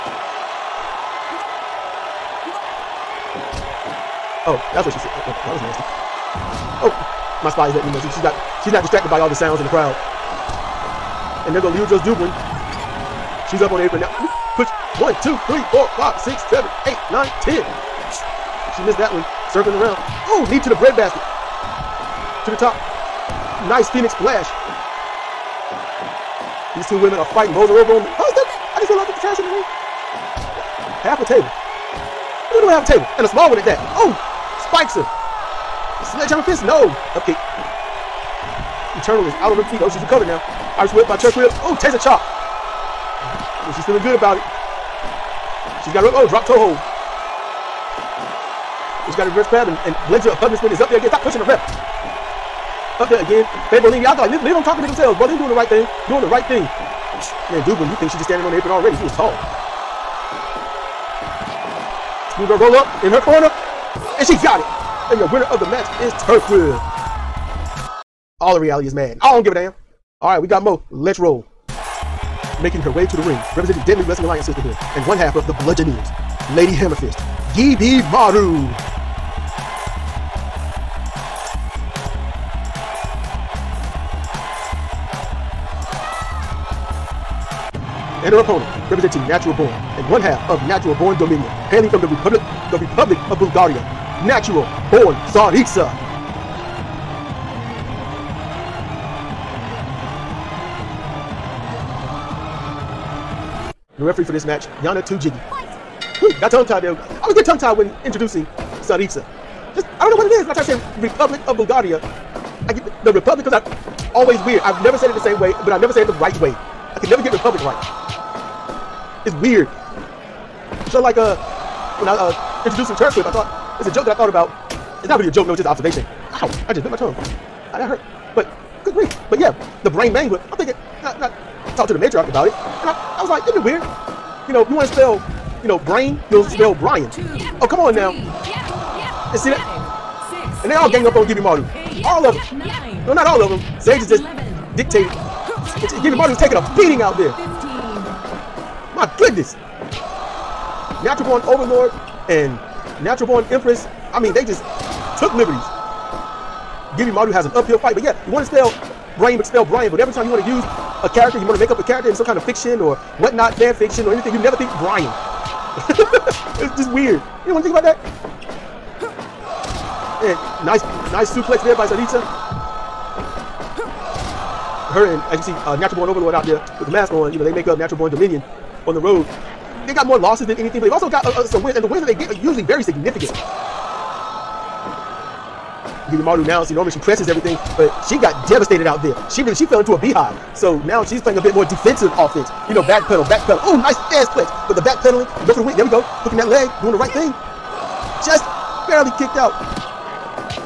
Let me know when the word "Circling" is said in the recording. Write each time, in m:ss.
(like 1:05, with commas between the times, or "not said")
0:19.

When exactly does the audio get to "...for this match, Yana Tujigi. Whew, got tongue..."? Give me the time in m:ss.
1:44.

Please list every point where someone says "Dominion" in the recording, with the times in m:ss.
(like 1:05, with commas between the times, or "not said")
1:31, 2:58.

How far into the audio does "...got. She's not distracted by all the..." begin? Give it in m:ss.
0:08.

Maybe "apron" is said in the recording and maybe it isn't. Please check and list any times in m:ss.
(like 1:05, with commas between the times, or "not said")
0:13, 0:58.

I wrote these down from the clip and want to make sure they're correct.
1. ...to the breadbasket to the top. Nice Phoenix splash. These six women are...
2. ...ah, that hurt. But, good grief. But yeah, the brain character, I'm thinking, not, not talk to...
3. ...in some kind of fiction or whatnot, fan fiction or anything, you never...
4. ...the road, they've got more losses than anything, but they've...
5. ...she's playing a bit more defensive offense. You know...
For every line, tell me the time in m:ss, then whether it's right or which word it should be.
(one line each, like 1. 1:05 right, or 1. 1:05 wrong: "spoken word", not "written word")
1. 0:20 wrong: "two", not "six"
2. 2:07 wrong: "mangler", not "character"
3. 2:42 right
4. 2:58 right
5. 3:11 right.